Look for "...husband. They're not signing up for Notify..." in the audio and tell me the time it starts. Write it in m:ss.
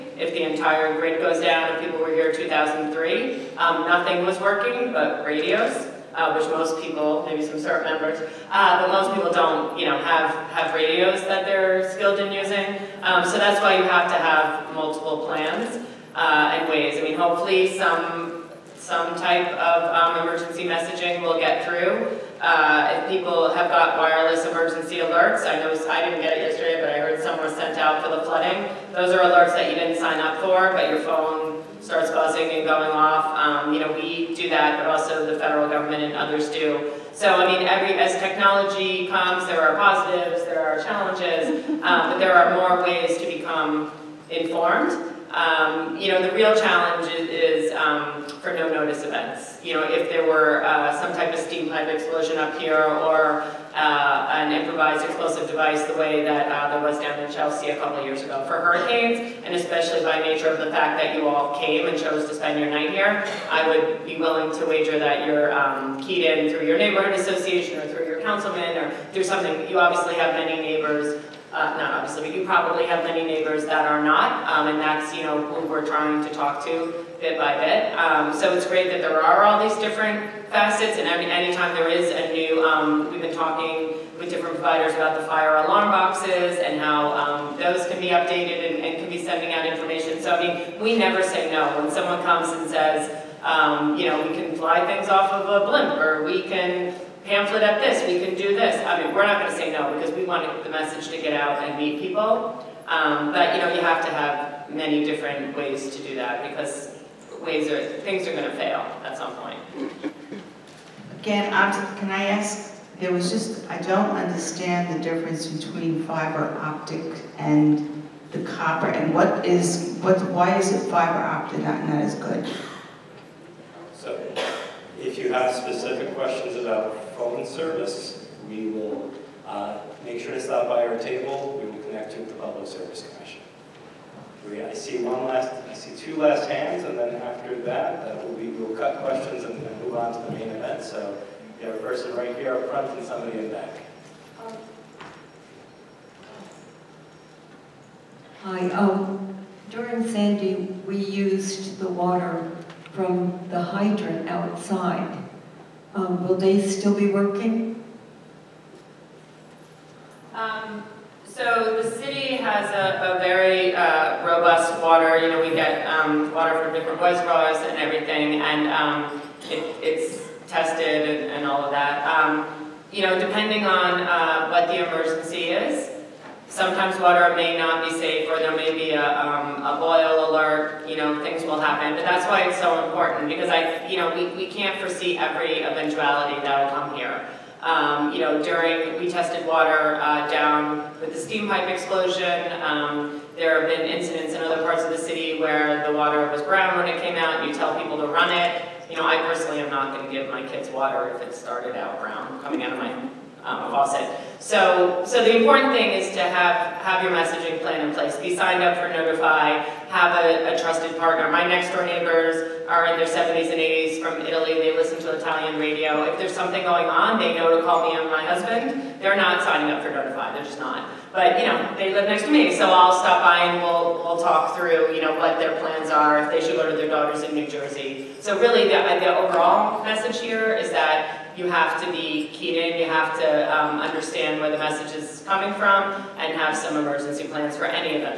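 3:38.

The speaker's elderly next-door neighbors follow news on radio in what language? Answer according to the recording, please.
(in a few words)
Italian.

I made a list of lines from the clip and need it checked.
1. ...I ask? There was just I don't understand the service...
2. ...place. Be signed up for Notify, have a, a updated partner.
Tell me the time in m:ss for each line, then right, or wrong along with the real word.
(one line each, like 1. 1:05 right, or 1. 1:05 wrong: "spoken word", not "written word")
1. 1:52 wrong: "difference", not "service"
2. 3:27 wrong: "trusted", not "updated".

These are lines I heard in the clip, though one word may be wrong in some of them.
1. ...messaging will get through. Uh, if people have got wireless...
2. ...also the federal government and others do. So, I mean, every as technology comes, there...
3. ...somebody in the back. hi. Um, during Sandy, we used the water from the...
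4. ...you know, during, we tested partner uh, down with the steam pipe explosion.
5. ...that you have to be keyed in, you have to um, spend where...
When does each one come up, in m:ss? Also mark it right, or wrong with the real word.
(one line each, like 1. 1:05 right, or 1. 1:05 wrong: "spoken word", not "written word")
1. 0:20 right
2. 0:34 right
3. 2:23 right
4. 3:08 wrong: "water", not "partner"
5. 3:50 wrong: "understand", not "spend".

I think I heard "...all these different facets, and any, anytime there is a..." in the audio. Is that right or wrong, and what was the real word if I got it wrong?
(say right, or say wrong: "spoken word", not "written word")
right.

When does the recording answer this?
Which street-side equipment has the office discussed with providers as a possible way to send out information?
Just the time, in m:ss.
1:25.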